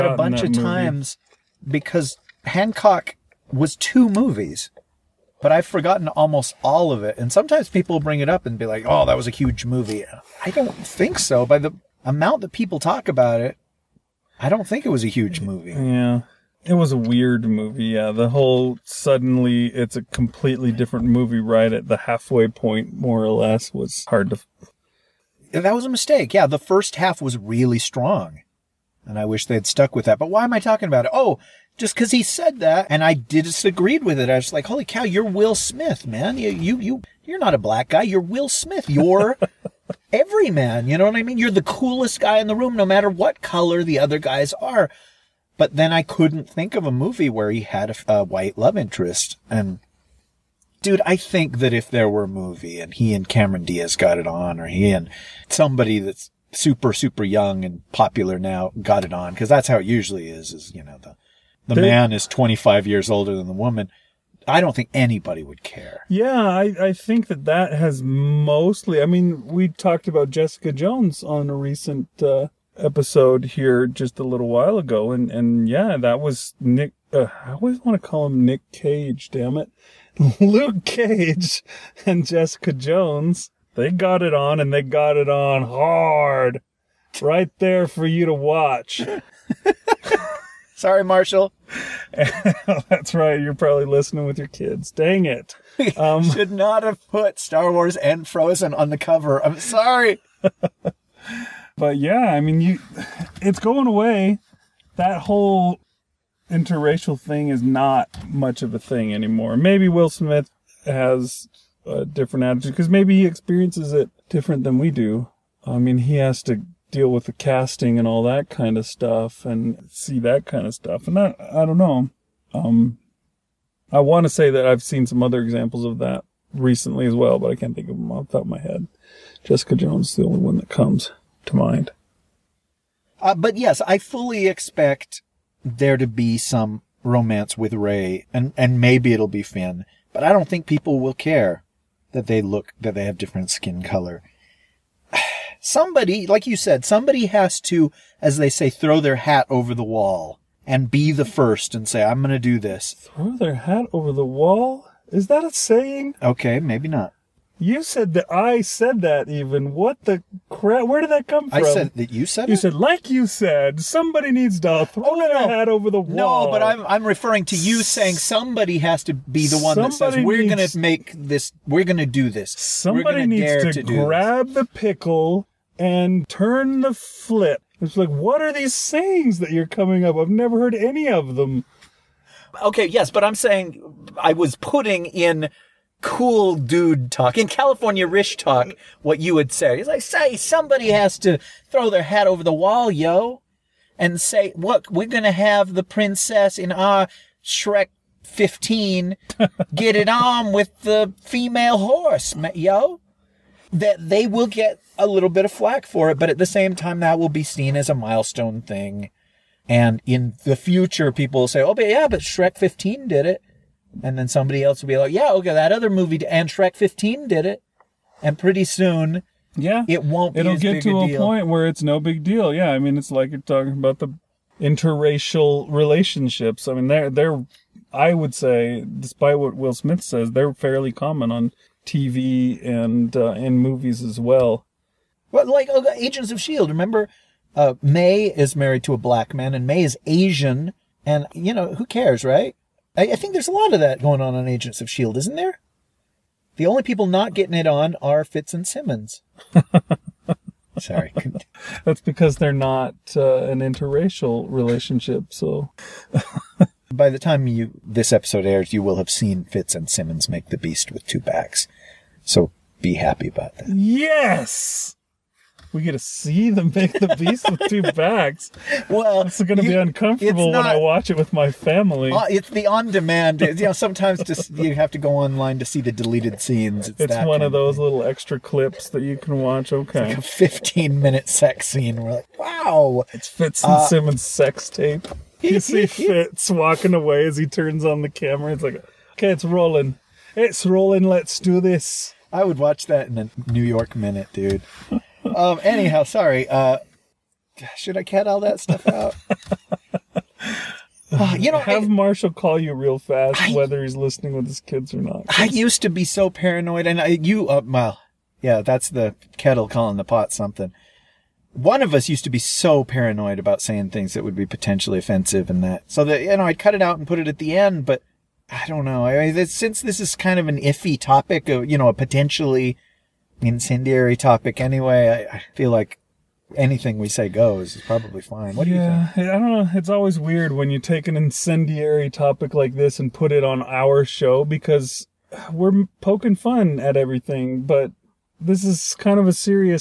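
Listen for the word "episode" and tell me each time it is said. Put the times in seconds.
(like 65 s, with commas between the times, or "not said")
72 s, 258 s.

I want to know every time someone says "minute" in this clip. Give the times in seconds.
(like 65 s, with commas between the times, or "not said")
280 s, 293 s.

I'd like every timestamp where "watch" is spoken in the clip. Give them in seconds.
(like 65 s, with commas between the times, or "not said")
88 s, 270 s, 279 s, 292 s.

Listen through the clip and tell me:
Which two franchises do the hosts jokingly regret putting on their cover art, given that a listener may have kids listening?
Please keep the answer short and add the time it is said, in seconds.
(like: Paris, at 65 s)
Star Wars and Frozen, at 97 s.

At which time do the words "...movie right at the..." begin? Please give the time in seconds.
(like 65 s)
21 s.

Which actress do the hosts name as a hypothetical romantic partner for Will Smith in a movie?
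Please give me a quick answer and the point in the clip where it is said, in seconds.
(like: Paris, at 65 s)
Cameron Diaz, at 53 s.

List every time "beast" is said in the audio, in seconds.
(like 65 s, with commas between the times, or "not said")
260 s, 267 s.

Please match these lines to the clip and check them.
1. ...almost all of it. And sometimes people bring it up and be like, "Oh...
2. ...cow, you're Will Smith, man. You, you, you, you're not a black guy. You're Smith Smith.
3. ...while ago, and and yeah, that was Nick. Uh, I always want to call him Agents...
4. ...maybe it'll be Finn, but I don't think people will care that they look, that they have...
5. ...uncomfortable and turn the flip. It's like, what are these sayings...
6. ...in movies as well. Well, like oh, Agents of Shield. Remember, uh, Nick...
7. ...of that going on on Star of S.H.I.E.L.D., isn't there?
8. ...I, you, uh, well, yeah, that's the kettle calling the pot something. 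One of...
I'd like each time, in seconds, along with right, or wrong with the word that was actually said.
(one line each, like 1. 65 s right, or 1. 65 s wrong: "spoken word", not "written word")
1. 6 s right
2. 34 s wrong: "Will", not "Smith"
3. 74 s wrong: "Nick", not "Agents"
4. 138 s right
5. 174 s wrong: "pickle", not "uncomfortable"
6. 233 s wrong: "May", not "Nick"
7. 243 s wrong: "Agents", not "Star"
8. 307 s right.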